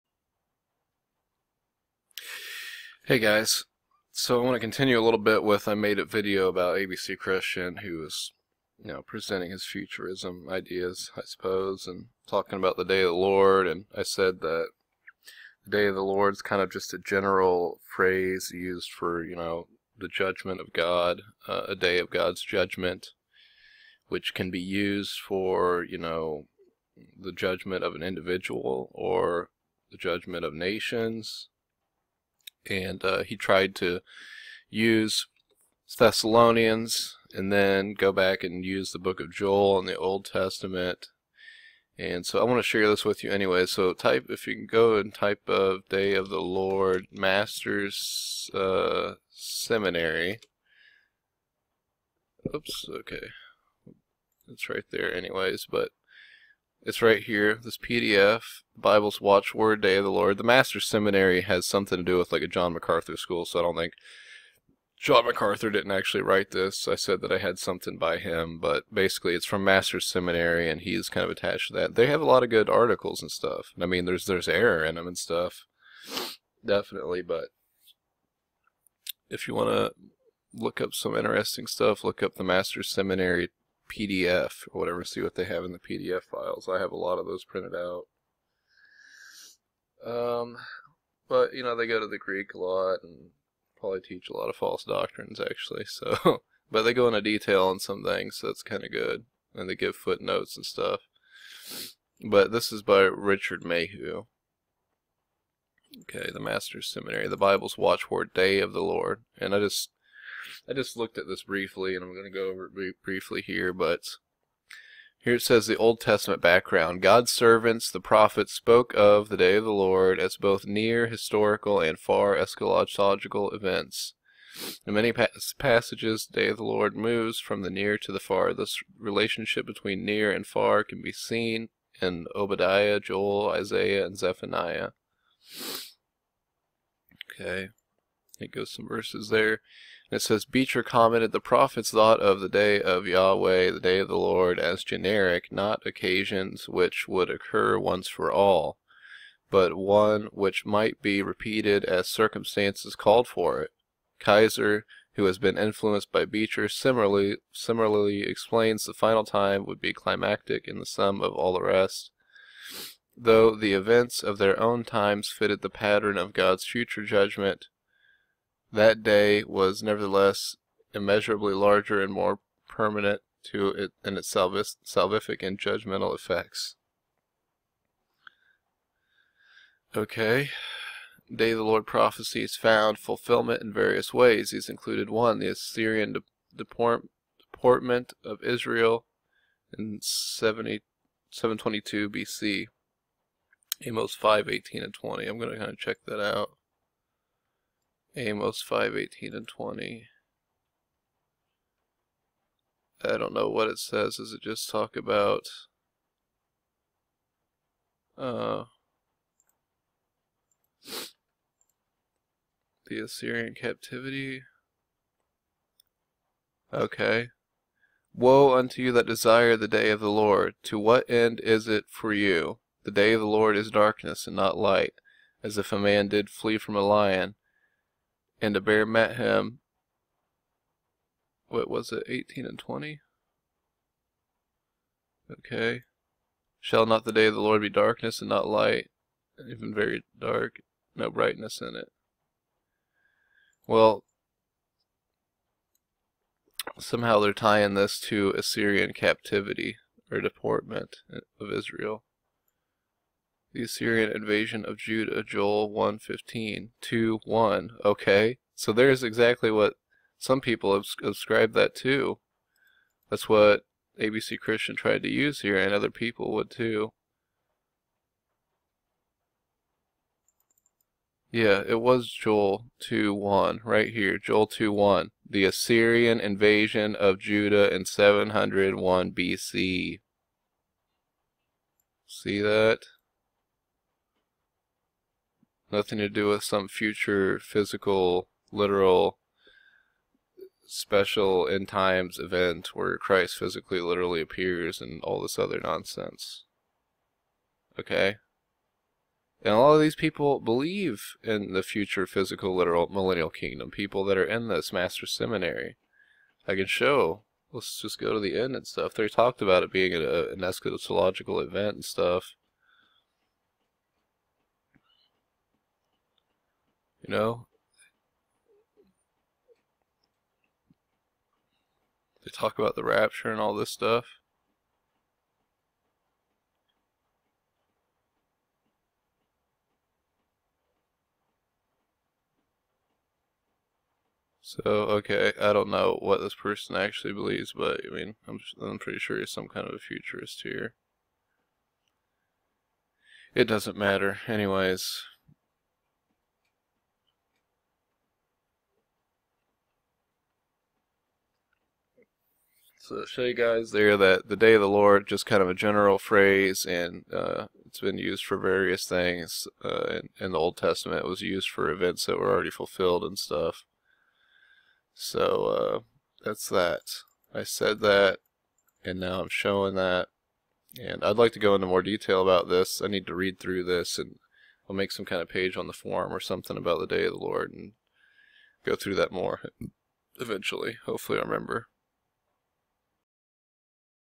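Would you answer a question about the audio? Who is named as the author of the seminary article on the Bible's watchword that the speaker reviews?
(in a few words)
Richard Mayhue.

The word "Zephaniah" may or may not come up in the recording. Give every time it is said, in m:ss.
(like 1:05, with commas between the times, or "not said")
2:14.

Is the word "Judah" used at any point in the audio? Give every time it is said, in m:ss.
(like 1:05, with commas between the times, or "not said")
4:14, 4:37.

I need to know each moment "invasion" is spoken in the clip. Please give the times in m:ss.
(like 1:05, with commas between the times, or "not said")
4:14, 4:36.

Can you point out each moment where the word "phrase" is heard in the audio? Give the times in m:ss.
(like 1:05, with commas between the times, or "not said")
0:17, 5:55.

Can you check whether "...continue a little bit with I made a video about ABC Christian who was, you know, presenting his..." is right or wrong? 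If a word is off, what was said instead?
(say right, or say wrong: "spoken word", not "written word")
right.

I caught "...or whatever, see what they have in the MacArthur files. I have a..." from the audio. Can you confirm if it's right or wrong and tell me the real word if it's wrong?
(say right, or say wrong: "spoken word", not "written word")
wrong: "PDF", not "MacArthur".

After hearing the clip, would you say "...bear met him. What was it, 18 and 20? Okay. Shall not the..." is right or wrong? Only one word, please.
right.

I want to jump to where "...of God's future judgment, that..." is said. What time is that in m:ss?
2:46.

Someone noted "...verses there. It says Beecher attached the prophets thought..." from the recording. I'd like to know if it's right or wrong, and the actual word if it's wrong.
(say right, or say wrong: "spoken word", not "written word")
wrong: "commented", not "attached".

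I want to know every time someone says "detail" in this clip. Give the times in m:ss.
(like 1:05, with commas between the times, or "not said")
1:37, 6:11.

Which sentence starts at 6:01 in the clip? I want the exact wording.
It was used for events that were already fulfilled and stuff.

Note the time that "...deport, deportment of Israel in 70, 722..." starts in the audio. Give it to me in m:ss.
3:06.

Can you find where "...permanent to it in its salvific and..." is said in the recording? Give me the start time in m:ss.
2:52.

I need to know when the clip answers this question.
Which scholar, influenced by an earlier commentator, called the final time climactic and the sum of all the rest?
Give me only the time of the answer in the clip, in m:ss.
2:34.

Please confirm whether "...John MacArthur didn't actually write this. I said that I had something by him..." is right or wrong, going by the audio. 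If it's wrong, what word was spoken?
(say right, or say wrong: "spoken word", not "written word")
right.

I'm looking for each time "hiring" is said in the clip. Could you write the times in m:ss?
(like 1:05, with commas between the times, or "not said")
not said.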